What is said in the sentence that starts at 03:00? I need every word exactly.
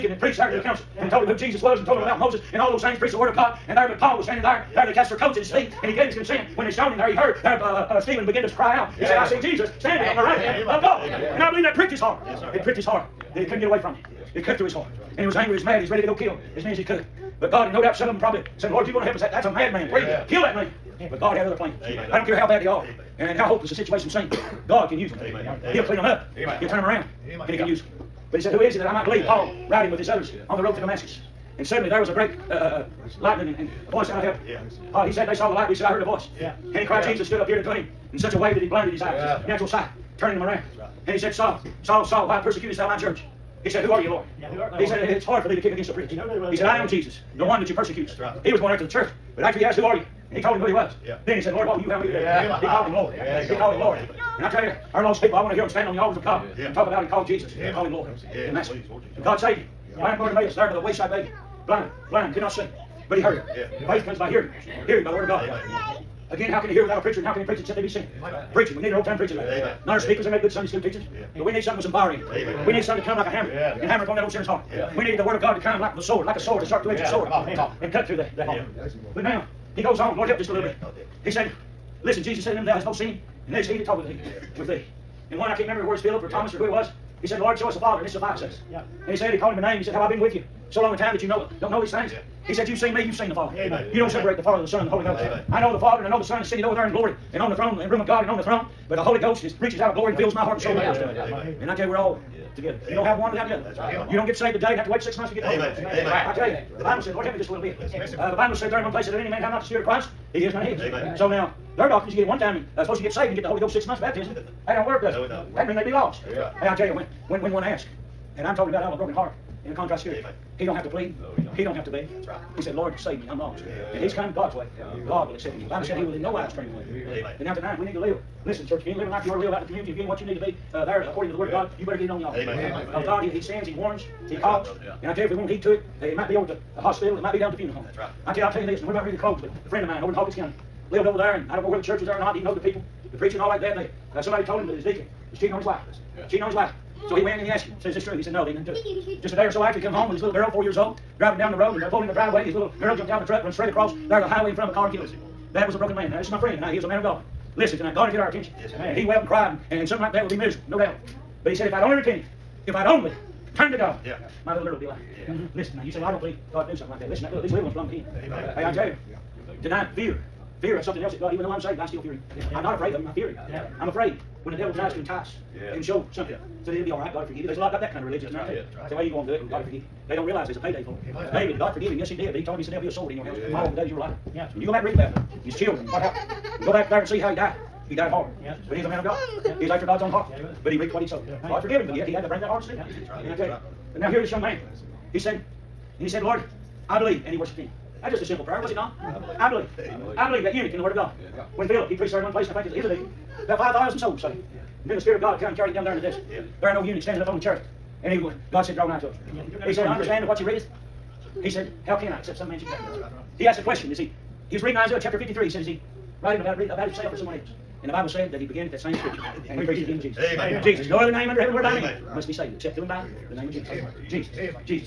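They don't realize there's a payday for it.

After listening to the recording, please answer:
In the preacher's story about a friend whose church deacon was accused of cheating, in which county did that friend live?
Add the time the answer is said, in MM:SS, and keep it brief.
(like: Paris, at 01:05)
Hawkins County, at 02:20.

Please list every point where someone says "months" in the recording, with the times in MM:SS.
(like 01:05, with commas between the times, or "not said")
01:45, 01:53.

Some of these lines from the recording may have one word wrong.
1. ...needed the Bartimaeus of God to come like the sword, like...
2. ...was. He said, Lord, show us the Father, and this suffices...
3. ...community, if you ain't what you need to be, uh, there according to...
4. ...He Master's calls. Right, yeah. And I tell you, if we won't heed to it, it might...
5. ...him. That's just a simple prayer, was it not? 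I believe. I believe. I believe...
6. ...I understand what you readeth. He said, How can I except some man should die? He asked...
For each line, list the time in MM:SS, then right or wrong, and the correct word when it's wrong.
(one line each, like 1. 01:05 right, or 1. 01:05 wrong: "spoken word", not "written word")
1. 01:15 wrong: "Word", not "Bartimaeus"
2. 01:26 right
3. 02:09 right
4. 02:14 wrong: "That", not "Master"
5. 03:17 right
6. 03:29 right.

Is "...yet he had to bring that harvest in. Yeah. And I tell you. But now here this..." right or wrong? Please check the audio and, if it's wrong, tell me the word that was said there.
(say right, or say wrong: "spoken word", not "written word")
right.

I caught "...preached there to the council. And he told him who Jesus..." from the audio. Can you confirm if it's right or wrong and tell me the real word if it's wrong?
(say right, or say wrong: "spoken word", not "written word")
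right.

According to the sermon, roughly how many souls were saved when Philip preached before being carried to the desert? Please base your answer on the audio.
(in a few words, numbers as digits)
5,000.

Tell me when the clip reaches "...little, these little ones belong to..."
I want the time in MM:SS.
02:47.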